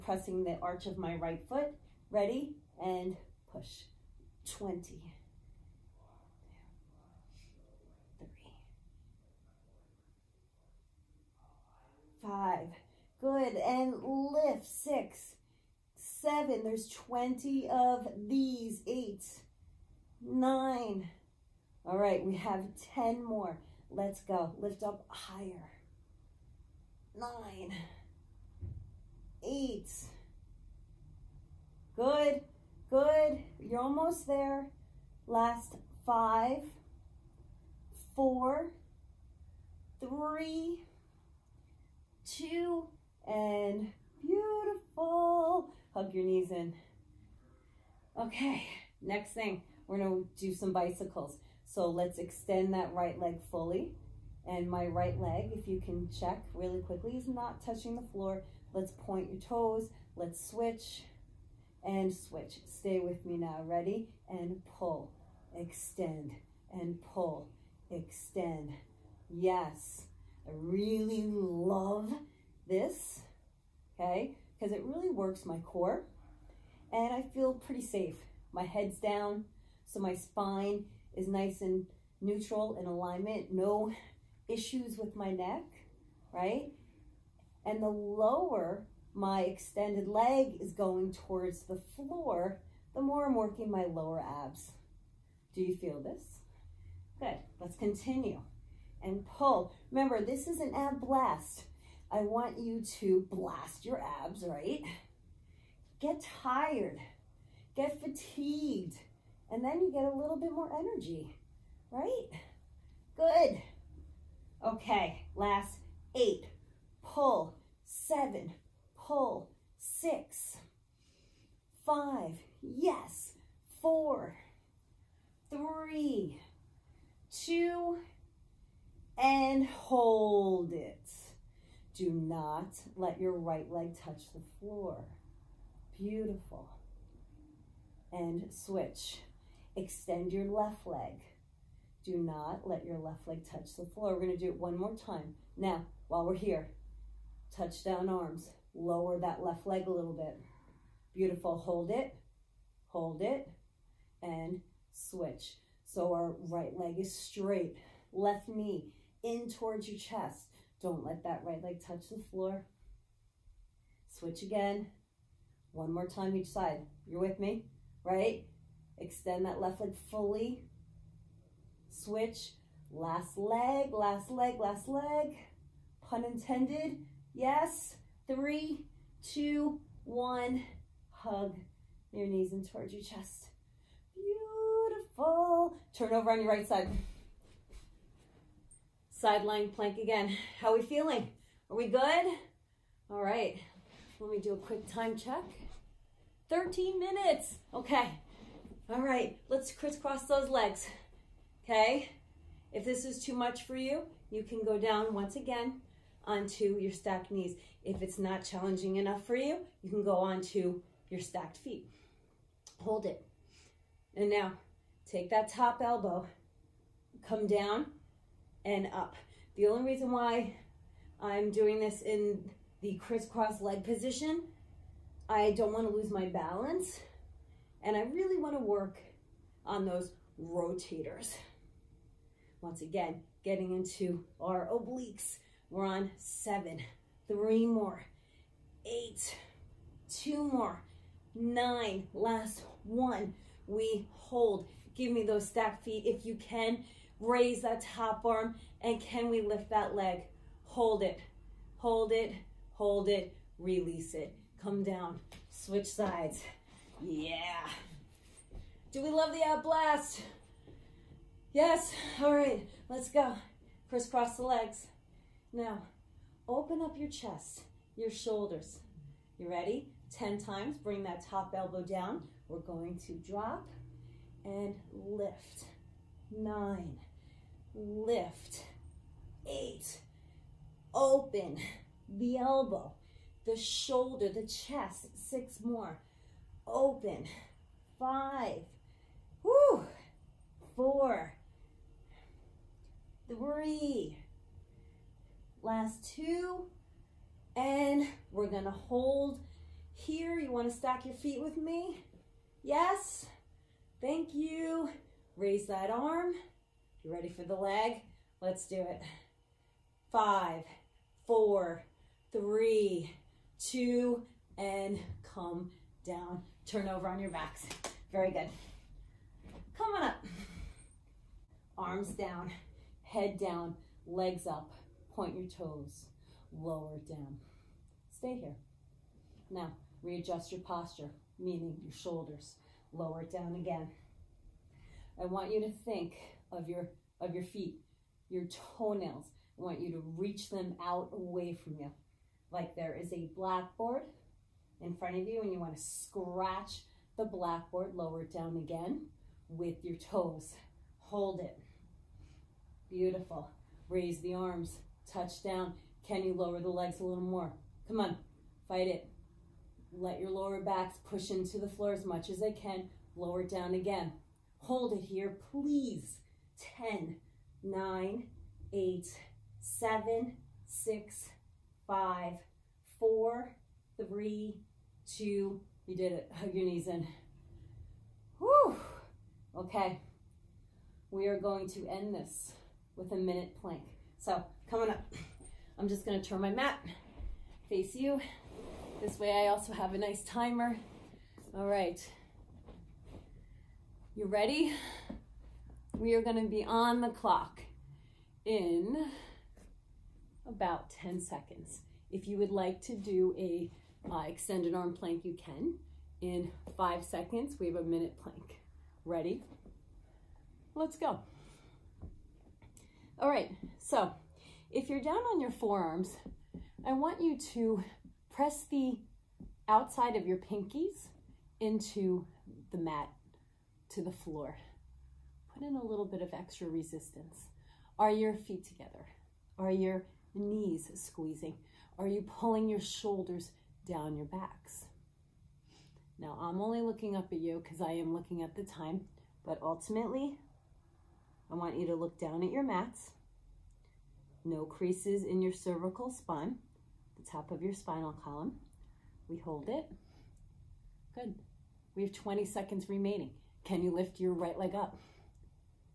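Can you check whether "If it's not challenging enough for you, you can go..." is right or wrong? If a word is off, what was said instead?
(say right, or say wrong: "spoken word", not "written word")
right.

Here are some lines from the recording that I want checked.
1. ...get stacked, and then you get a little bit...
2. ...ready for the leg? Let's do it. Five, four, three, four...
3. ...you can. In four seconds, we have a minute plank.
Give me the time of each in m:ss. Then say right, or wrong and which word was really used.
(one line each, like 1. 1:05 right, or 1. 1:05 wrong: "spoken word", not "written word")
1. 1:47 wrong: "fatigued", not "stacked"
2. 5:07 wrong: "two", not "four"
3. 6:45 wrong: "five", not "four".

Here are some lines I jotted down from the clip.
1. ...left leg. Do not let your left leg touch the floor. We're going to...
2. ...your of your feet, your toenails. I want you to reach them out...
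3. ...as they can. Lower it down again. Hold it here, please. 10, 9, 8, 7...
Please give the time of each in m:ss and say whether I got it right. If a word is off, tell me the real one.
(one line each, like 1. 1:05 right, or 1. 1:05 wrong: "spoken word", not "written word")
1. 2:20 right
2. 5:36 right
3. 6:02 right.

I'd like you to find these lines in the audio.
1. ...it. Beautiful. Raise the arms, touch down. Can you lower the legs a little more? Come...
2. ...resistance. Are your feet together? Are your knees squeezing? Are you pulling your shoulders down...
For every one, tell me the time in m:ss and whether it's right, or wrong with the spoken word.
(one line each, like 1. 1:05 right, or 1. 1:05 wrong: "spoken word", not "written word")
1. 5:51 right
2. 7:06 right.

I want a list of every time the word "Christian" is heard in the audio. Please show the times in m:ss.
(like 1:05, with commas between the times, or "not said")
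not said.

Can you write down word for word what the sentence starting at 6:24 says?
So coming up, I'm just going to turn my mat, face you.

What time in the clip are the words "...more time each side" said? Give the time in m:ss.
2:45.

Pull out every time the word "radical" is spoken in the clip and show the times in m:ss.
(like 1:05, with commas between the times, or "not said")
not said.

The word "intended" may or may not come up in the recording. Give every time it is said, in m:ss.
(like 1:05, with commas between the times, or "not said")
2:56.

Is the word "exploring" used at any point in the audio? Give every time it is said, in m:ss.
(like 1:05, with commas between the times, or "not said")
not said.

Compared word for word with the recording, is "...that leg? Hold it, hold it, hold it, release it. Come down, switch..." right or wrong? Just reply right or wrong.
right.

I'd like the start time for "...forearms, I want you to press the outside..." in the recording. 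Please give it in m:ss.
6:55.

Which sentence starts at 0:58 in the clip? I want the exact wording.
Let's point your toes, let's switch and switch.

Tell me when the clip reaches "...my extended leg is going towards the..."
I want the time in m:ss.
1:29.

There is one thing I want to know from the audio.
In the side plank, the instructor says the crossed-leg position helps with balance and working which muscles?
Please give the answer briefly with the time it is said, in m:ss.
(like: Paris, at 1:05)
rotators, at 3:50.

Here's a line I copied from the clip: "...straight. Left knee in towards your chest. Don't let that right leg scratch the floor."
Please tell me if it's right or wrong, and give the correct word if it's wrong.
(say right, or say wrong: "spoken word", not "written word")
wrong: "touch", not "scratch".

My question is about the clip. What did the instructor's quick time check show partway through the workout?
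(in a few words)
13 minutes.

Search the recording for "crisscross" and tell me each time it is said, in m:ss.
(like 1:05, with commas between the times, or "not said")
3:19, 3:42, 4:23.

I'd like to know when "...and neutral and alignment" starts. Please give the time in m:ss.
1:21.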